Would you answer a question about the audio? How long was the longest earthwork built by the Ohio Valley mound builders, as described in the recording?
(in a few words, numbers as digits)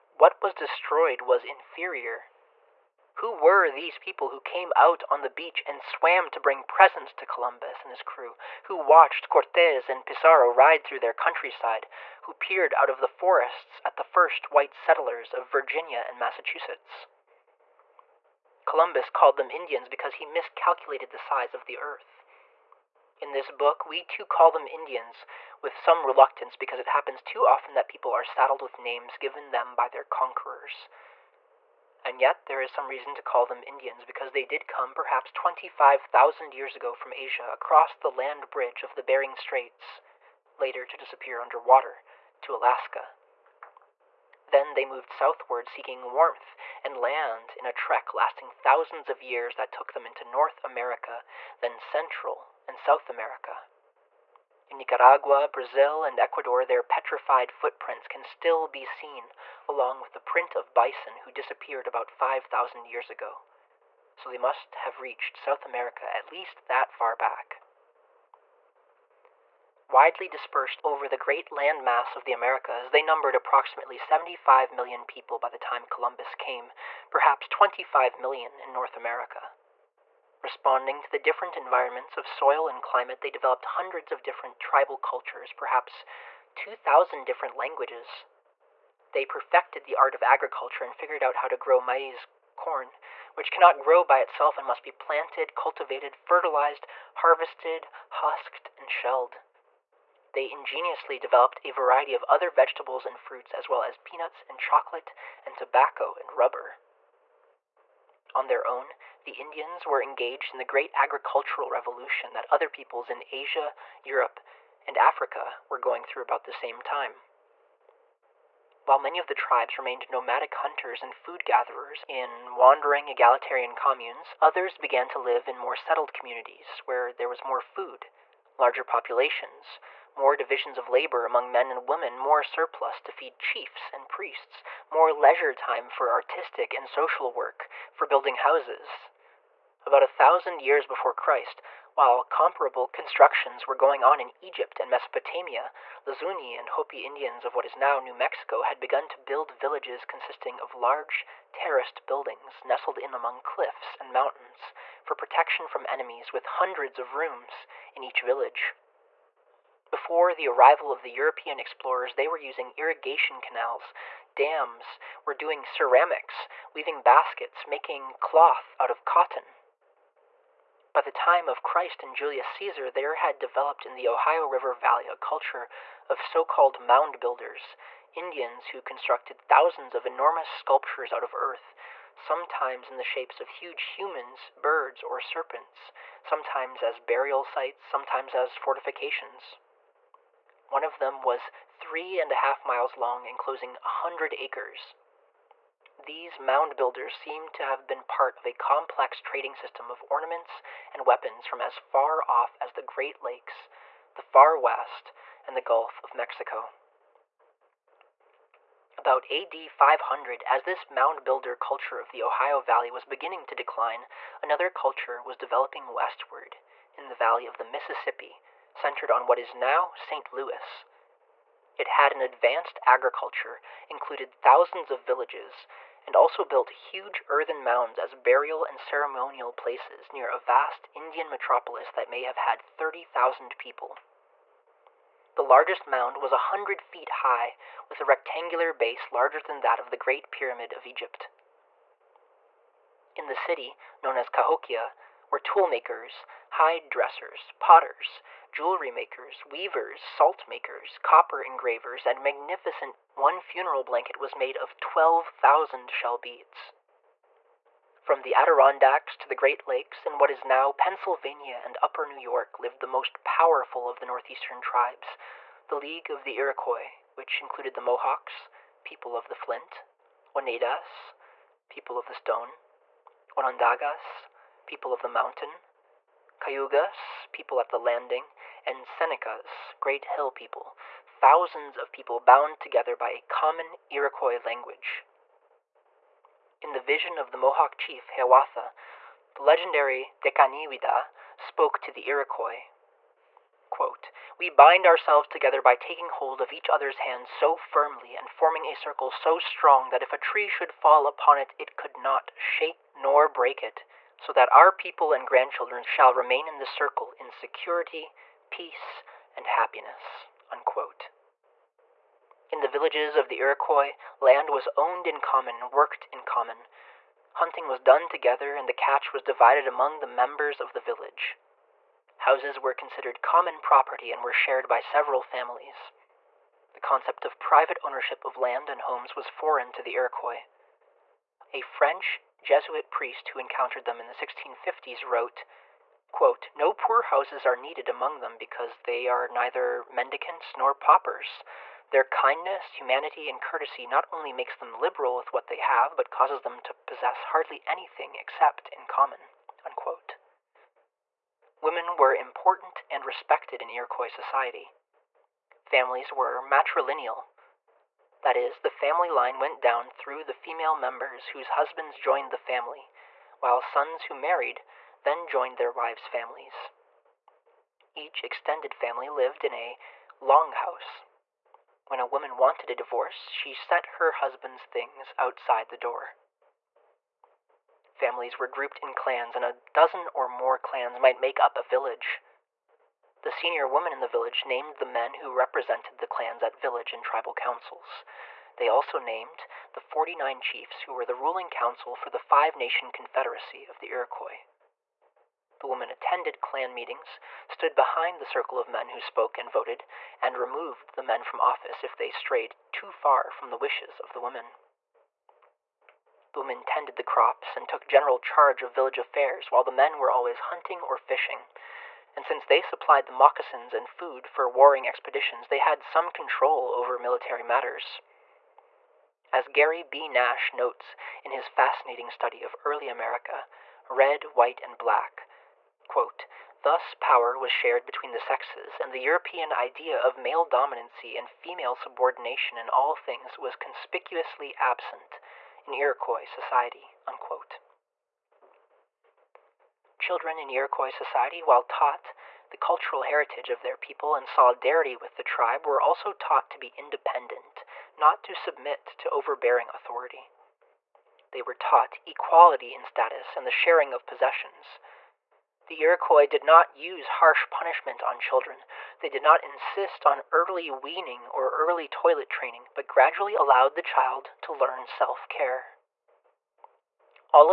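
3.5 miles.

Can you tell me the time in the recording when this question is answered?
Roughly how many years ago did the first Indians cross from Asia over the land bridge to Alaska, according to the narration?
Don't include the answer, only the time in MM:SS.
00:35.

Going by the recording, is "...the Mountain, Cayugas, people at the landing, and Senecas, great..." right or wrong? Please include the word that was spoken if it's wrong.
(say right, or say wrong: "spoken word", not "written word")
right.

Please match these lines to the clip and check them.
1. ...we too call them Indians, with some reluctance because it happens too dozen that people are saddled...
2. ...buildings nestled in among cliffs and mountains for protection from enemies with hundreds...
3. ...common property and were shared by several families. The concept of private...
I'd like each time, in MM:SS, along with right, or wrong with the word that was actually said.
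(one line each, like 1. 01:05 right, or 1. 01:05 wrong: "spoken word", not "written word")
1. 00:23 wrong: "often", not "dozen"
2. 02:32 right
3. 05:23 right.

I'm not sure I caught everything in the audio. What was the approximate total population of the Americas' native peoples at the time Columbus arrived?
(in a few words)
75 million.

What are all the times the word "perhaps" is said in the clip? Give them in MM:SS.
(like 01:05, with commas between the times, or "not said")
00:34, 01:17, 01:25.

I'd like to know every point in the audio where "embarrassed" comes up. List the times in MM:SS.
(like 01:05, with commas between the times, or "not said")
not said.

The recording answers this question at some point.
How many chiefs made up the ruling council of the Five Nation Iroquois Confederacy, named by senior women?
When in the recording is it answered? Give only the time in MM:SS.
06:29.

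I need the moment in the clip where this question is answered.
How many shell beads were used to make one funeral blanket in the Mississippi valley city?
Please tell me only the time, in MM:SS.
04:14.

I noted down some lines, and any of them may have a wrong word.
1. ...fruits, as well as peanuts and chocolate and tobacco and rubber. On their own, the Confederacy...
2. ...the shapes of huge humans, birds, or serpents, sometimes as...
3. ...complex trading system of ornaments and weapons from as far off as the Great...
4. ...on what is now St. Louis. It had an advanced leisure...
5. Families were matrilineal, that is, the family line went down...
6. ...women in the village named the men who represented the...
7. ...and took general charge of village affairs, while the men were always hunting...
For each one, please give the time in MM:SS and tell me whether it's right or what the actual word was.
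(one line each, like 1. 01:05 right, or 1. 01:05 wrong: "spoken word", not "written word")
1. 01:43 wrong: "Indians", not "Confederacy"
2. 03:02 right
3. 03:18 right
4. 03:39 wrong: "agriculture", not "leisure"
5. 05:55 right
6. 06:23 right
7. 06:47 right.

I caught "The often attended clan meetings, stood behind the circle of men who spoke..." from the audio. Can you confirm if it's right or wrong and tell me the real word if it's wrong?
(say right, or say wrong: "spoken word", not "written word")
wrong: "women", not "often".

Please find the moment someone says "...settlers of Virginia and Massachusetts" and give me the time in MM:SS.
00:14.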